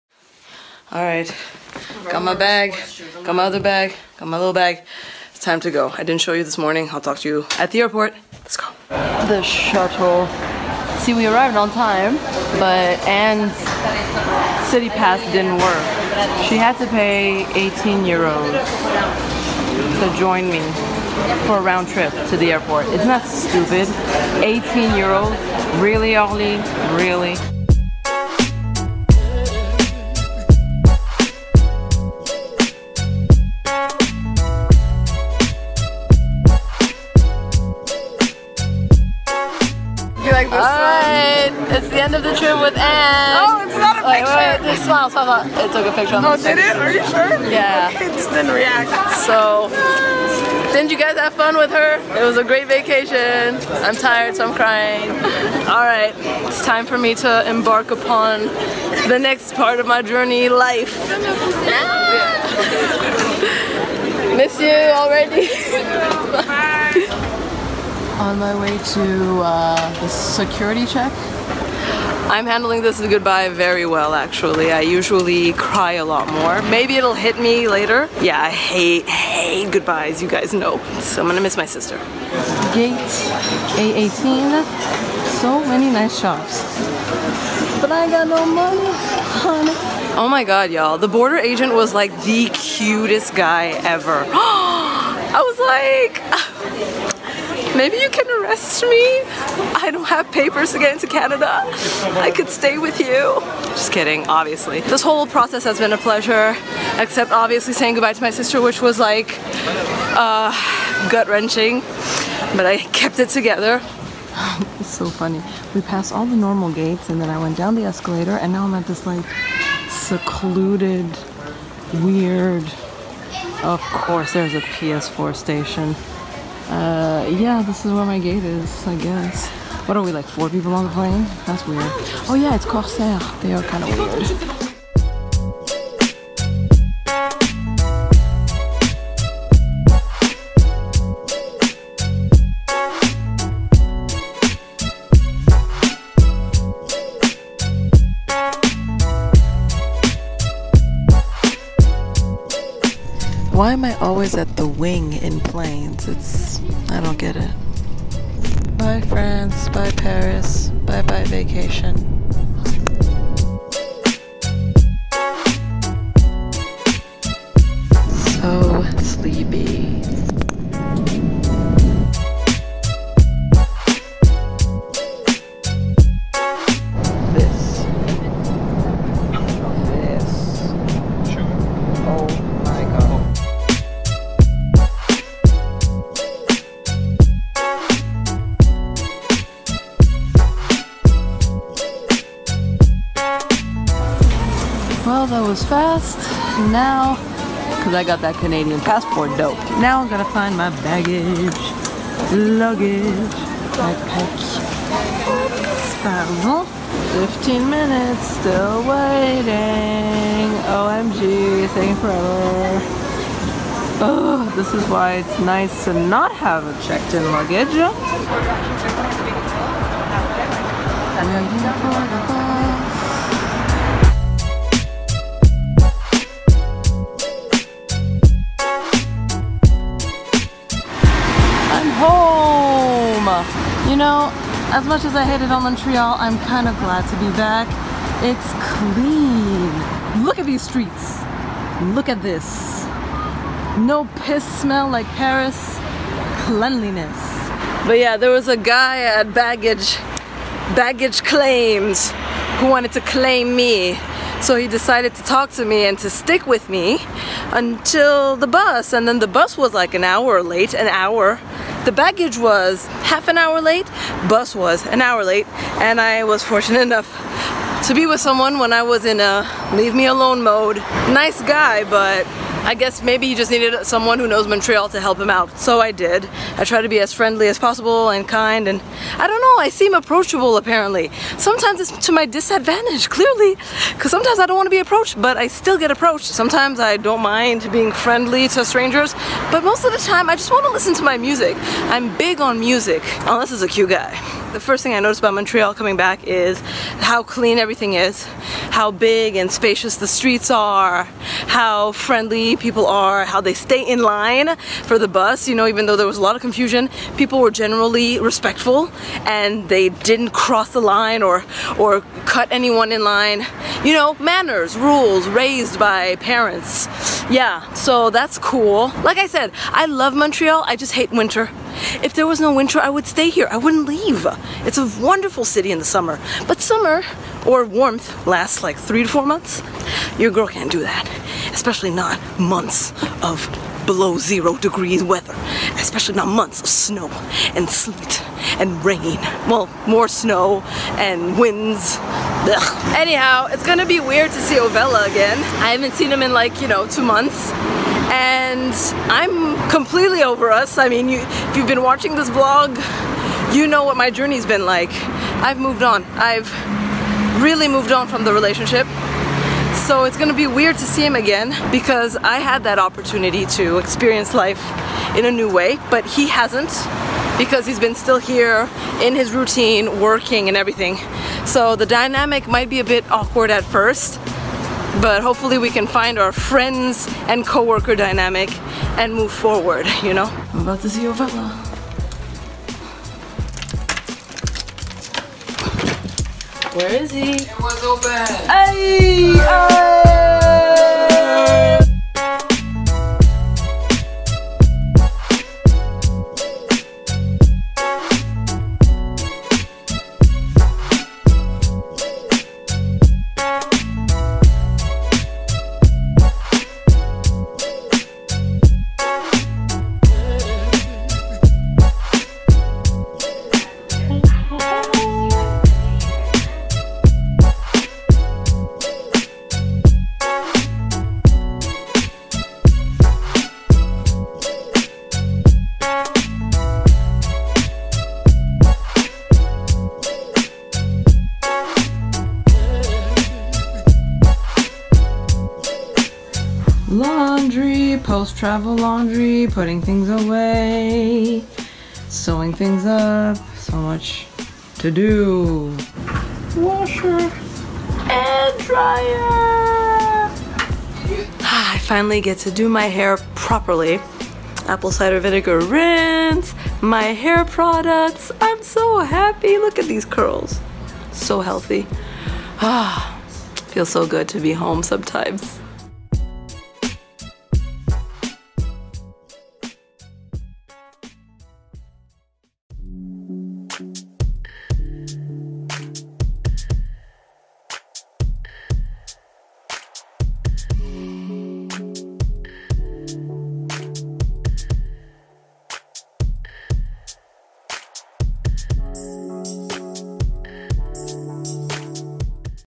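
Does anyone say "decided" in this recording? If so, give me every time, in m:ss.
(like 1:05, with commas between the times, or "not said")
4:14.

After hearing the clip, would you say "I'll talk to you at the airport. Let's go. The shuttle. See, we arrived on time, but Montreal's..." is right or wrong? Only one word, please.
wrong.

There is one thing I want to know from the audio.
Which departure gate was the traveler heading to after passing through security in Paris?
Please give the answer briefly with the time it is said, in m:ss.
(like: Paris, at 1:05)
A18, at 1:22.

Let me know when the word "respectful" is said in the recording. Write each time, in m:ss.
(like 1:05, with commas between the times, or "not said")
5:08.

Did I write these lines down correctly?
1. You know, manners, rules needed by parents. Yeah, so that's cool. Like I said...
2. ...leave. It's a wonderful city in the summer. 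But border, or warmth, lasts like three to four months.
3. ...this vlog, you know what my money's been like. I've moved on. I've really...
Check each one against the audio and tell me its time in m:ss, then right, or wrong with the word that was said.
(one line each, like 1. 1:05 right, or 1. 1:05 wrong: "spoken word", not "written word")
1. 5:13 wrong: "raised", not "needed"
2. 5:23 wrong: "summer", not "border"
3. 5:52 wrong: "journey", not "money".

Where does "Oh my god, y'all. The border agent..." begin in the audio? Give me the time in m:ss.
1:30.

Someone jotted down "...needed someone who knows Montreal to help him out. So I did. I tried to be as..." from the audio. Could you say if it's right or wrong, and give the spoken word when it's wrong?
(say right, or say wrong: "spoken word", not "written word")
right.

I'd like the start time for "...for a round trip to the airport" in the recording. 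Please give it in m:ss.
0:21.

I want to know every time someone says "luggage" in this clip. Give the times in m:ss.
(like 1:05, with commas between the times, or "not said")
3:22, 3:37.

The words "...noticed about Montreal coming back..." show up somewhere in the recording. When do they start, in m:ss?
4:54.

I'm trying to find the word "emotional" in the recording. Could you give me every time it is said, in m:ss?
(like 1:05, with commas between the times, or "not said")
not said.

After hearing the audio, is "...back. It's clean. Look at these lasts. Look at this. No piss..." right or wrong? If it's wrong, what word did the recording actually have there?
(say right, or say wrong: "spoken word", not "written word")
wrong: "streets", not "lasts".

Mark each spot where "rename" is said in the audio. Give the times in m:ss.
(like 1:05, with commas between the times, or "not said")
not said.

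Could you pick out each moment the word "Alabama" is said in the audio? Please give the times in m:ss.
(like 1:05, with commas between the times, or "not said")
not said.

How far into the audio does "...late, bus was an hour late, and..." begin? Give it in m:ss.
4:23.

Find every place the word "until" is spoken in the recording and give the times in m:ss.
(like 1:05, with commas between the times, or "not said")
4:17.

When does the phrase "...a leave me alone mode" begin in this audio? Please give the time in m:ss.
4:29.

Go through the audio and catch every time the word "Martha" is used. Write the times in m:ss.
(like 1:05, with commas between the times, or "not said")
not said.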